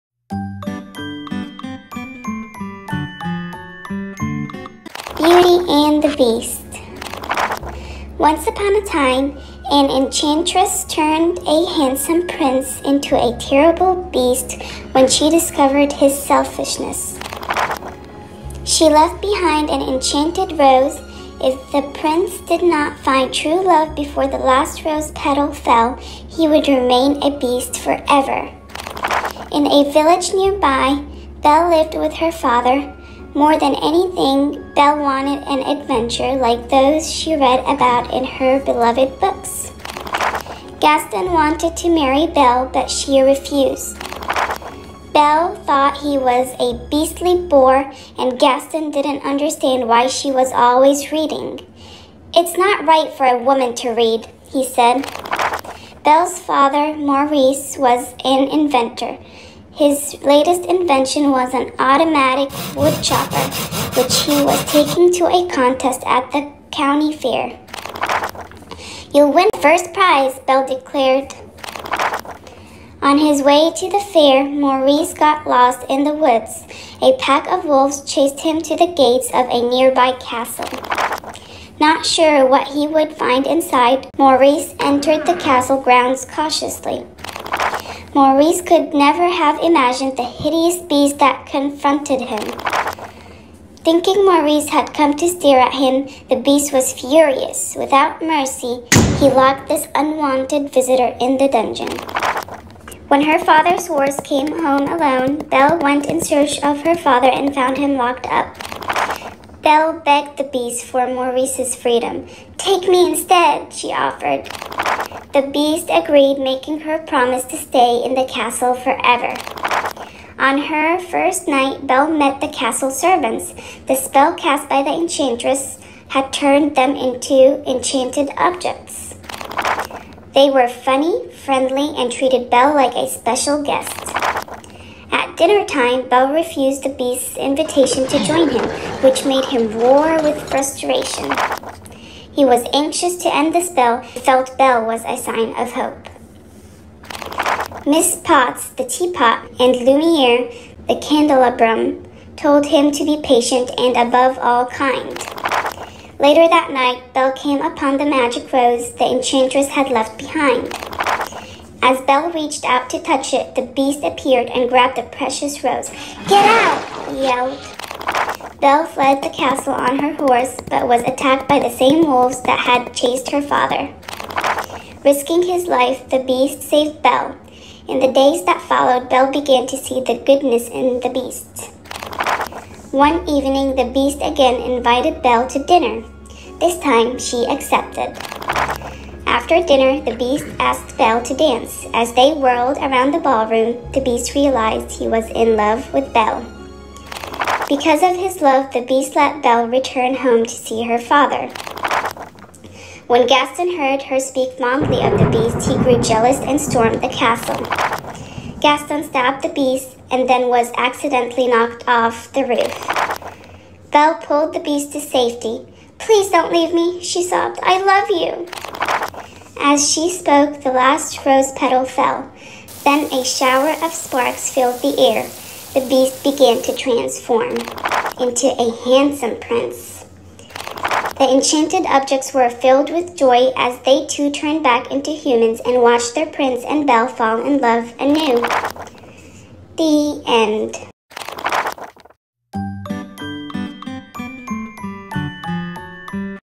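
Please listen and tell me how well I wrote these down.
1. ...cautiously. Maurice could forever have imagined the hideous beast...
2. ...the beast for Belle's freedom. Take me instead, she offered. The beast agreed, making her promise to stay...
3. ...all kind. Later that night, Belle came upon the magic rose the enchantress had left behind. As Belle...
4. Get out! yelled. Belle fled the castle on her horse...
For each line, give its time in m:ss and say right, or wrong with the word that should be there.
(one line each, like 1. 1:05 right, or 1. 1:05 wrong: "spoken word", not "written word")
1. 1:26 wrong: "never", not "forever"
2. 1:50 wrong: "Maurice", not "Belle"
3. 2:34 right
4. 2:46 right.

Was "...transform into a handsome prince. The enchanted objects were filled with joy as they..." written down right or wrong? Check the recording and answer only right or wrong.
right.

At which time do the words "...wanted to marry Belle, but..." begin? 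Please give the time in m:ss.
0:41.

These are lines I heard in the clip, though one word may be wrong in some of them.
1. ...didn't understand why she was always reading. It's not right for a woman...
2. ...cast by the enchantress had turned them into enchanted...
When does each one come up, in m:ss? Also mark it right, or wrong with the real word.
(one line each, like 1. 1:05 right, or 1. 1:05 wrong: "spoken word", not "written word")
1. 0:48 right
2. 2:04 right.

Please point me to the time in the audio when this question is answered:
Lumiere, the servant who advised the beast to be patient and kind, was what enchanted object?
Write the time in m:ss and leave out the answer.
2:31.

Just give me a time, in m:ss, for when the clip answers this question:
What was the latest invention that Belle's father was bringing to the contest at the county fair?
1:01.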